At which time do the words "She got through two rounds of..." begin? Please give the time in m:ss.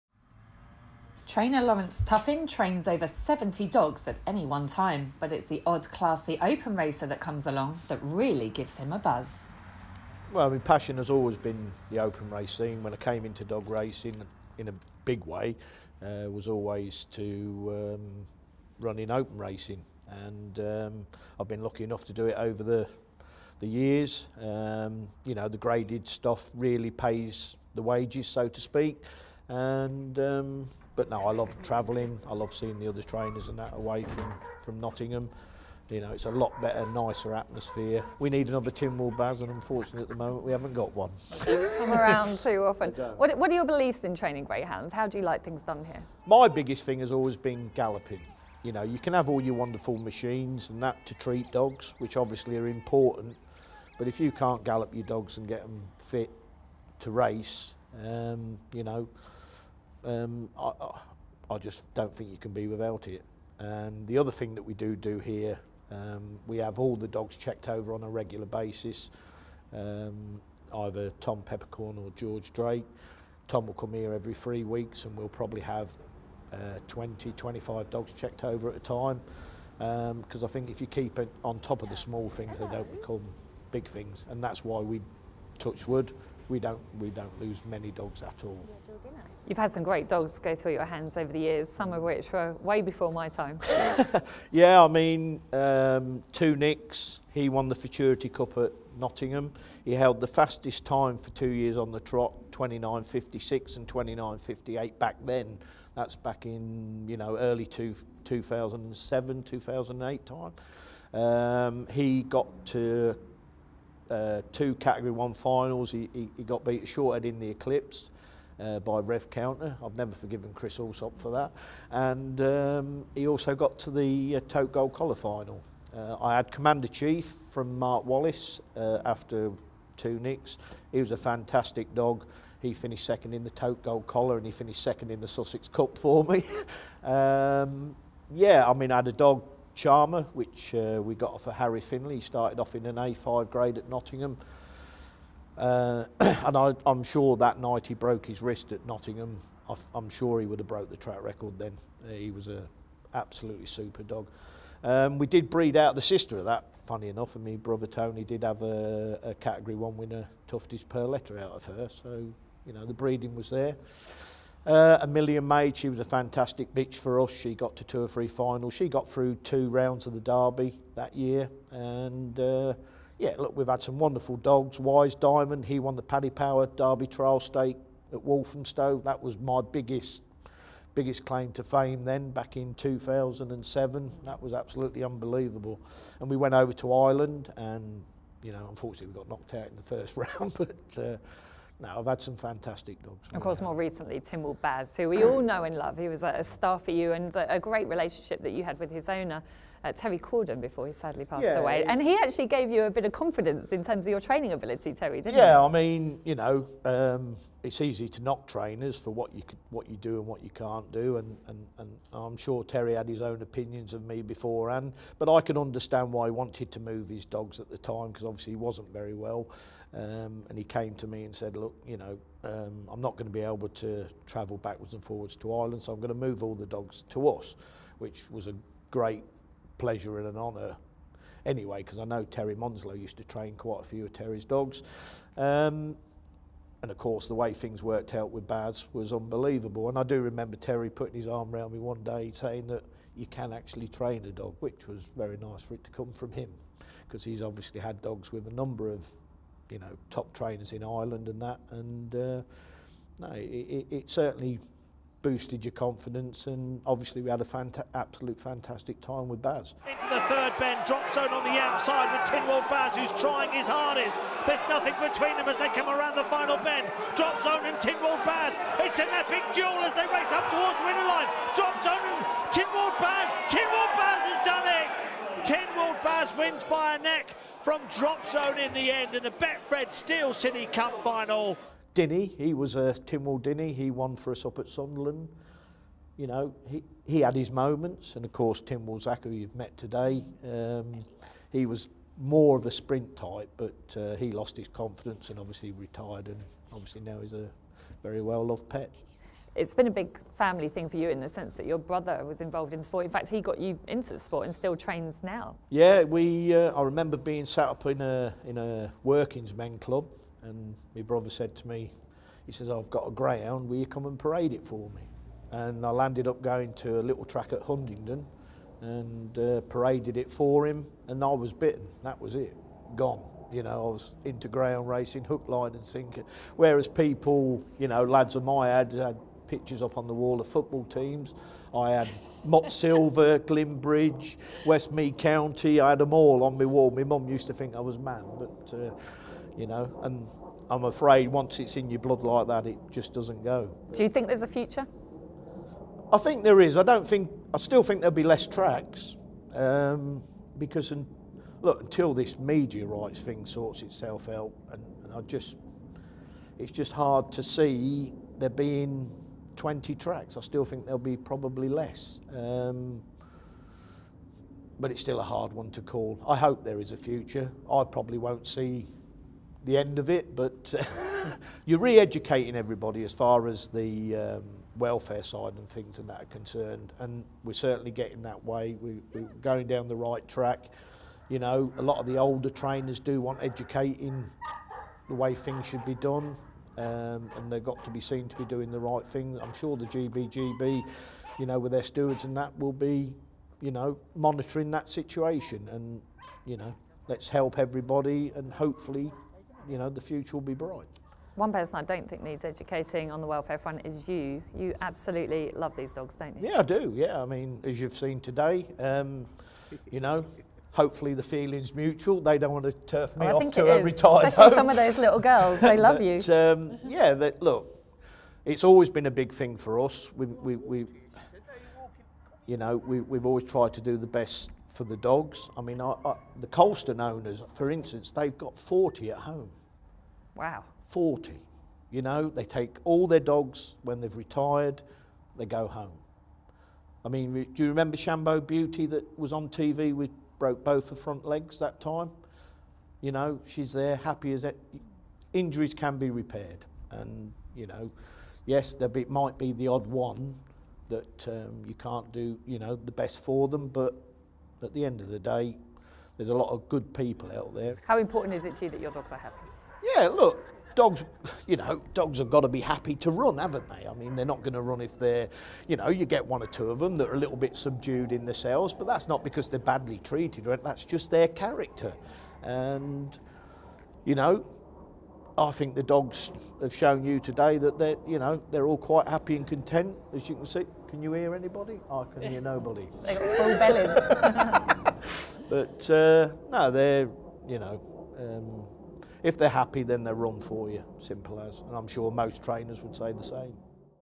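2:48.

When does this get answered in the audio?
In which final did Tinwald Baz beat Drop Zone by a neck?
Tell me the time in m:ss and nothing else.
4:39.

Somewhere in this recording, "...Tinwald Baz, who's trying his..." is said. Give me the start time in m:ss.
4:22.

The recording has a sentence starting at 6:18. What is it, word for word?
We, we're going down the right track.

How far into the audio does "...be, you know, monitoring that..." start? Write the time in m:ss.
6:32.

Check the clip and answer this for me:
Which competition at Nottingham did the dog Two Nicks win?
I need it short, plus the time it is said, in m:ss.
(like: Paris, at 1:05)
Futurity Cup, at 1:37.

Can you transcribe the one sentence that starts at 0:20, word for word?
And um, I've been lucky enough to do it over the, the years.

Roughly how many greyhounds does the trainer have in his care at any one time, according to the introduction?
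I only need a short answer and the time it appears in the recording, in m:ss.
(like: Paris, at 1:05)
over 70, at 0:02.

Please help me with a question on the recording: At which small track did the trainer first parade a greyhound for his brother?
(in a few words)
Huntingdon.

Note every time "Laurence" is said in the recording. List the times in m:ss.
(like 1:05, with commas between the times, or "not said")
0:01.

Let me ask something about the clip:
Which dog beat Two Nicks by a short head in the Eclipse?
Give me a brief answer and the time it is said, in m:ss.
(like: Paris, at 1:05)
Rev Counter, at 1:58.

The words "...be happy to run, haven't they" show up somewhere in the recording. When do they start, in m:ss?
7:42.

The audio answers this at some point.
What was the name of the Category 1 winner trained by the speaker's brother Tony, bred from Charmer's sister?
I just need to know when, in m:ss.
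2:40.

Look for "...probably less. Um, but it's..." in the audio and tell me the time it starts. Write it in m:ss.
6:01.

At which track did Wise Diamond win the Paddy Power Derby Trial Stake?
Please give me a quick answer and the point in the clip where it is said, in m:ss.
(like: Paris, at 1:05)
Walthamstow, at 2:58.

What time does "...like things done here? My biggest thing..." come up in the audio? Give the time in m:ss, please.
0:45.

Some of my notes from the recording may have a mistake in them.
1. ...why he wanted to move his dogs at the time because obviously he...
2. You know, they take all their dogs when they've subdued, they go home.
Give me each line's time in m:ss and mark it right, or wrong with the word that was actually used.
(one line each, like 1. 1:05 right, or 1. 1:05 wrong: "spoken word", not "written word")
1. 3:36 right
2. 7:11 wrong: "retired", not "subdued".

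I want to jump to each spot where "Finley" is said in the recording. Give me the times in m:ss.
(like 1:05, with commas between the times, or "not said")
2:21.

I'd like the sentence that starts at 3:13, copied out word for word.
Of course, more recently, Tim Baz, who we all know and love.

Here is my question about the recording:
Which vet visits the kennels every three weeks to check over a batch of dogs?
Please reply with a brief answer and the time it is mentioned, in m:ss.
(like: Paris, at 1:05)
Tom Peppercorn, at 1:11.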